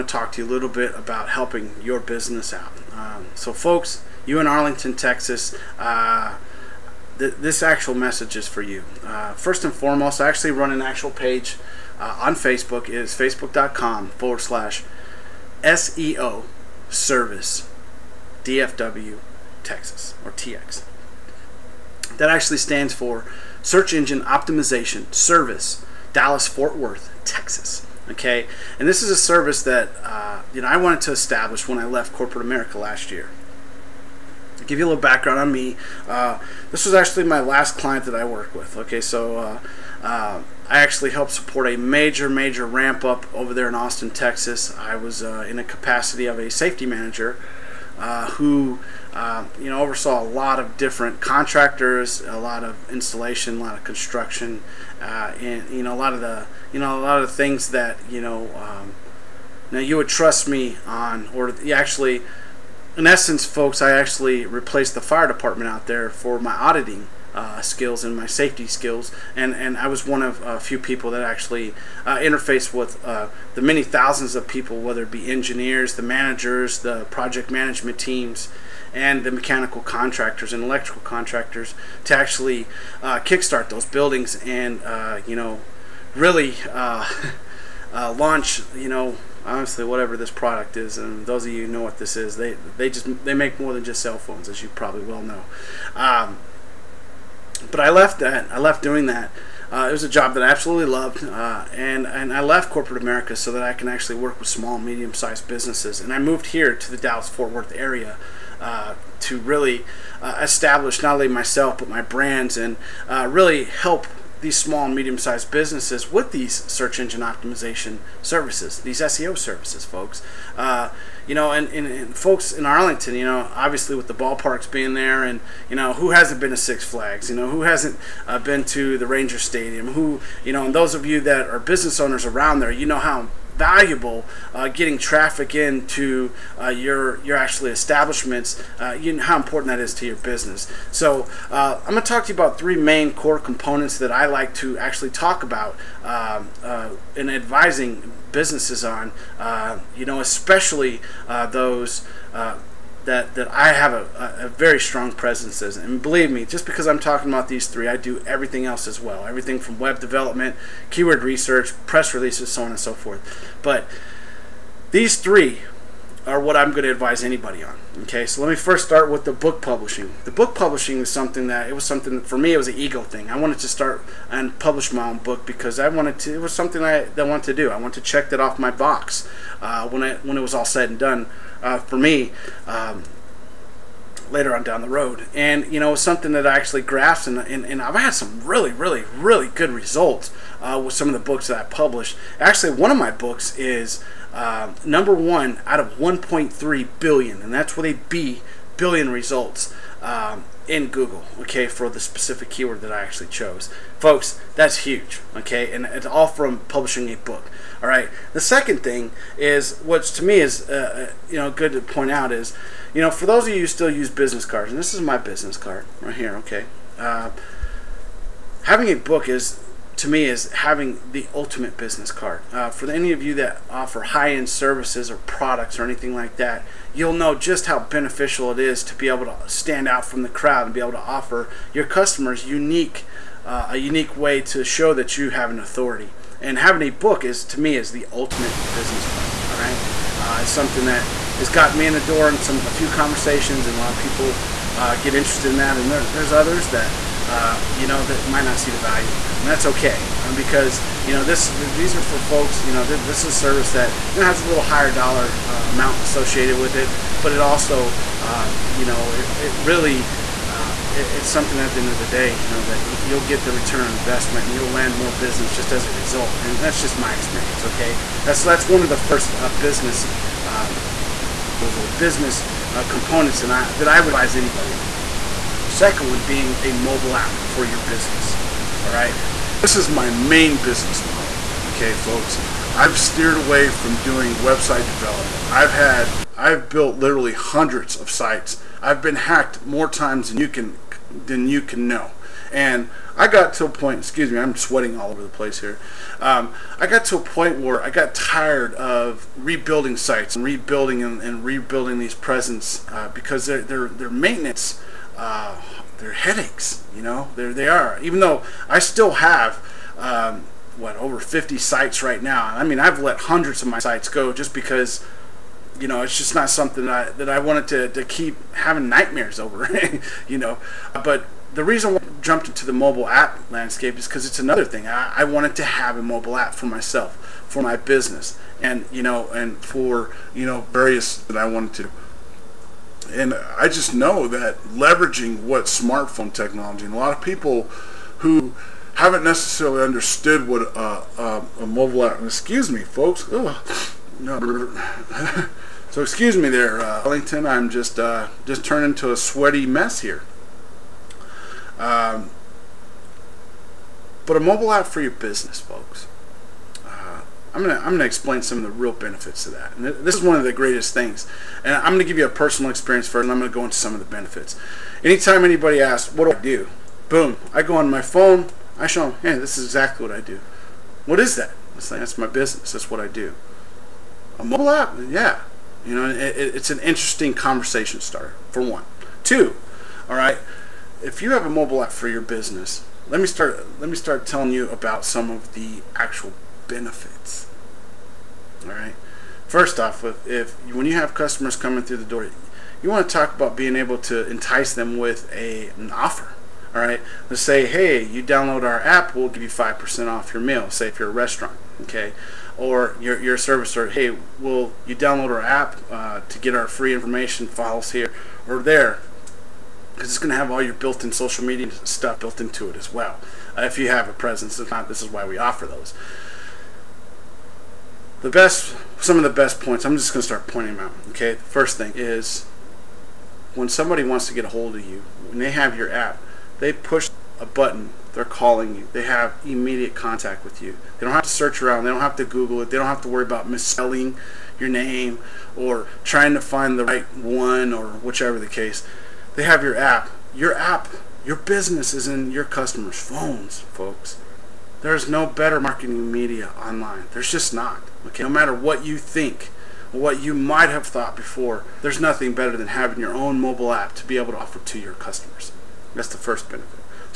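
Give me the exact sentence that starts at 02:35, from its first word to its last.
And believe me, just because I'm talking about these three, I do everything else as well.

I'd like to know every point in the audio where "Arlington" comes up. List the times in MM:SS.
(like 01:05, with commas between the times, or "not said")
00:04, 02:02.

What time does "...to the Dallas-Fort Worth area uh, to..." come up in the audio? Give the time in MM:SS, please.
01:46.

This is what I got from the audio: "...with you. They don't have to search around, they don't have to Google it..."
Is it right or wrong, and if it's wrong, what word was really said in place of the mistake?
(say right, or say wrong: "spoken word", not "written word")
right.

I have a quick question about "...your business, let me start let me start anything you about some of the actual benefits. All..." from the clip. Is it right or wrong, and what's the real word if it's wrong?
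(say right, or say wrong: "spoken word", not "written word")
wrong: "telling", not "anything".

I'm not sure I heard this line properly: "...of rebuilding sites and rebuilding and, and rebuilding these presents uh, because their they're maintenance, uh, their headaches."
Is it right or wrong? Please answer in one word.
right.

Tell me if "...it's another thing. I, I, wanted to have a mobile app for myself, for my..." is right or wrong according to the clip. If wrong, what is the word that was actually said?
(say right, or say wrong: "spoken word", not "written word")
right.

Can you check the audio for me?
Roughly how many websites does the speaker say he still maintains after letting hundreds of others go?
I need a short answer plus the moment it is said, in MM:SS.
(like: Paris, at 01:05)
over 50, at 05:10.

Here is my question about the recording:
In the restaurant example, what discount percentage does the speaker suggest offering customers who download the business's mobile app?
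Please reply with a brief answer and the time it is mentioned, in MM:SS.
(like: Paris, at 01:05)
5%, at 06:39.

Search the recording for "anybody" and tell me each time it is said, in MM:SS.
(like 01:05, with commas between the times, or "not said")
02:47, 04:34, 06:05.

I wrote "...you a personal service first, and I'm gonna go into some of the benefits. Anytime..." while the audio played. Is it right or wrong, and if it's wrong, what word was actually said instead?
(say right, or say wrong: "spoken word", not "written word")
wrong: "experience", not "service".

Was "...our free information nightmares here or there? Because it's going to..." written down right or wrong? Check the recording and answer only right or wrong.
wrong.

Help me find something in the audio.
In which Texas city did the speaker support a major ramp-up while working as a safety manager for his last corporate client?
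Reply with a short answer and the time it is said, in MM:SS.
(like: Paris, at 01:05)
Austin, at 00:43.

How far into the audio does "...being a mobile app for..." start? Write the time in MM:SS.
04:36.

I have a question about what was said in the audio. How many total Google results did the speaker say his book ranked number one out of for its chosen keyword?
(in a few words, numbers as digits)
1.3 billion.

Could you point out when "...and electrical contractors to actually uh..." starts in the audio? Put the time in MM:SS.
01:20.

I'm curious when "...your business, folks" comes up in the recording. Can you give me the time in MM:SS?
05:55.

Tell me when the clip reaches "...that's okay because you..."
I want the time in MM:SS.
04:09.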